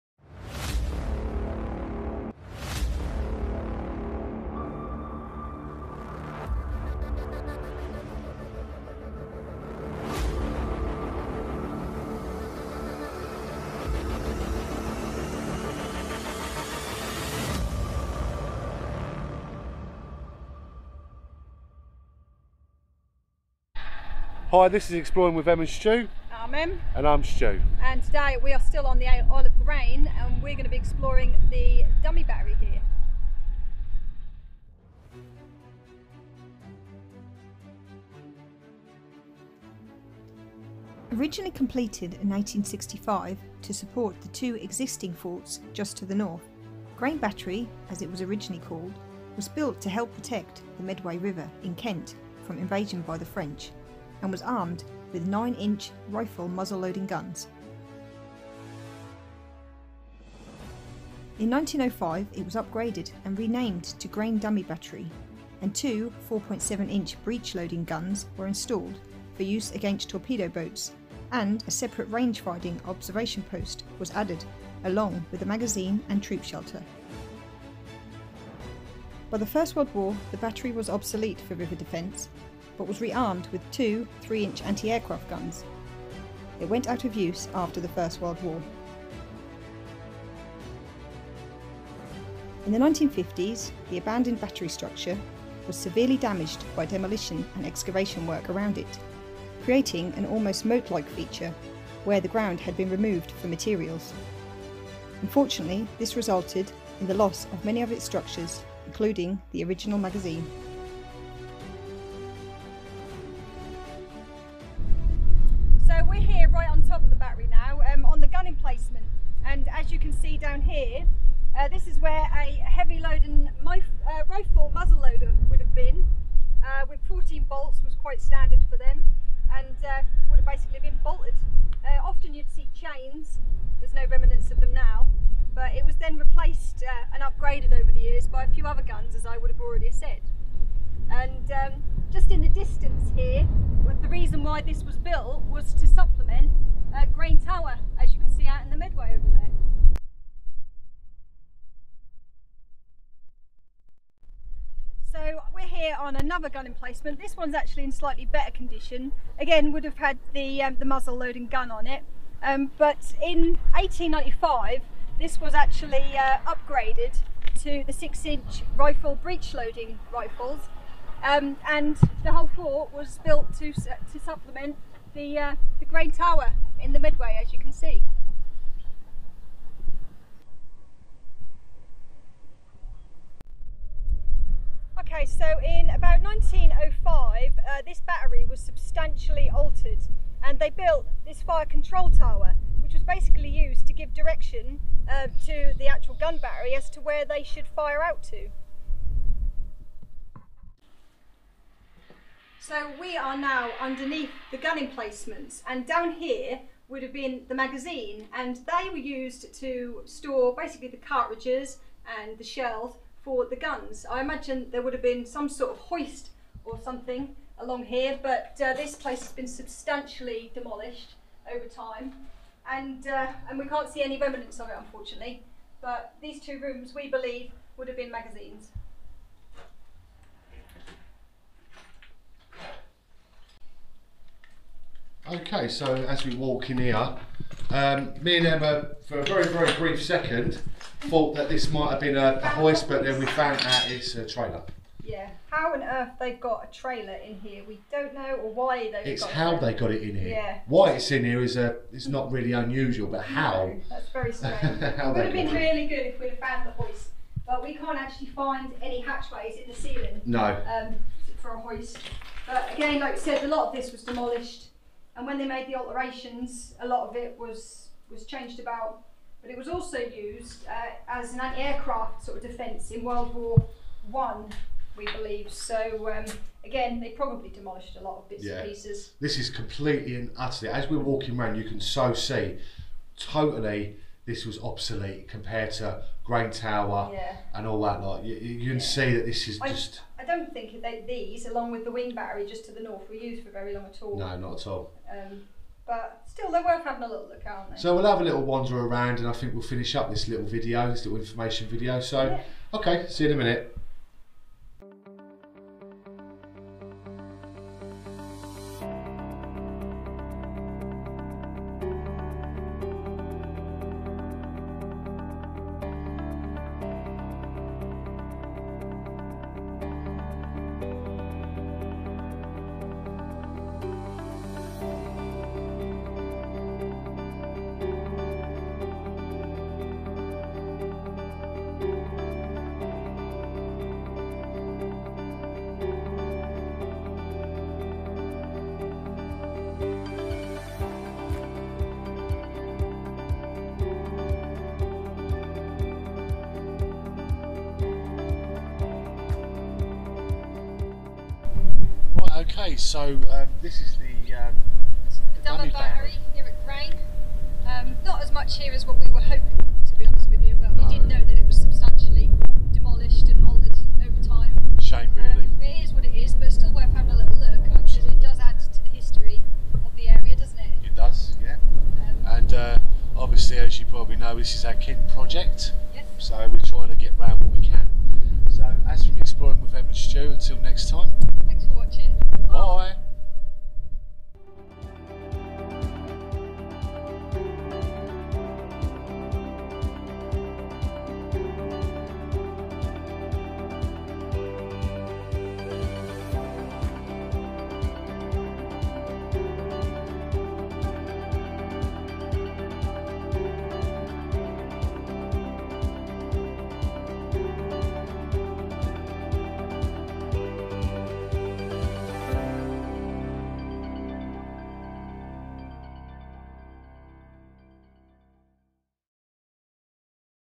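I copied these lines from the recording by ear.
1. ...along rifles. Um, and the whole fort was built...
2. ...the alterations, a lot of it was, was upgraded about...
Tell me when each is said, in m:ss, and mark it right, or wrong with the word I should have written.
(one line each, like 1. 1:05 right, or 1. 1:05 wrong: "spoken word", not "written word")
1. 2:49 wrong: "loading", not "along"
2. 4:25 wrong: "changed", not "upgraded".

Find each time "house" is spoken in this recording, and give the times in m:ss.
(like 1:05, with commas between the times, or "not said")
not said.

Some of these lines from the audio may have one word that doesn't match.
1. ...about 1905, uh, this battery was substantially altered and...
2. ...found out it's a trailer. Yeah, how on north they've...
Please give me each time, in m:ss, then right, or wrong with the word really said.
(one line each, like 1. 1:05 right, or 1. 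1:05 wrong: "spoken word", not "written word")
1. 3:05 right
2. 4:03 wrong: "earth", not "north".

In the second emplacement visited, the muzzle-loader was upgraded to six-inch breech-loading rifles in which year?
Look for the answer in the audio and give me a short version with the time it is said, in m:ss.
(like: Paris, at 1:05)
1895, at 2:43.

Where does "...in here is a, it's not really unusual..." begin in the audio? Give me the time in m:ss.
4:11.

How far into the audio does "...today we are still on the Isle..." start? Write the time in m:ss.
0:28.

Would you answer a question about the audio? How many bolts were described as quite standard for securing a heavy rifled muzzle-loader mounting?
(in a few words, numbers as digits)
14.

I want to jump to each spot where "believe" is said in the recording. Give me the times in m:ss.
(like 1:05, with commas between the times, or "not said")
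3:47, 4:35.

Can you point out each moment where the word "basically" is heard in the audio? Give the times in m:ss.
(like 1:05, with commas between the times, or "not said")
2:10, 3:13, 3:30.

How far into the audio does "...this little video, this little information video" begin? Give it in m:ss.
5:00.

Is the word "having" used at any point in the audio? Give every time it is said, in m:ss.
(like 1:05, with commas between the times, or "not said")
4:56, 6:06.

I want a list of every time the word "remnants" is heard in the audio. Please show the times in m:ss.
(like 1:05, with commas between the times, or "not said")
2:14, 3:44.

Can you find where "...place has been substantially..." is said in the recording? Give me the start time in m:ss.
3:38.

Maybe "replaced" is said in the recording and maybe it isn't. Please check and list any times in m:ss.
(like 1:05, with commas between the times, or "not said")
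2:16.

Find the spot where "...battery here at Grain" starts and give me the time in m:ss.
5:55.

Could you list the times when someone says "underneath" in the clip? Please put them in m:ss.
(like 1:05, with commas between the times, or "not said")
3:23.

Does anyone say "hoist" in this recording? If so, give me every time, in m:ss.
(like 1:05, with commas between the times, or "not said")
3:35, 4:02, 4:16, 4:21.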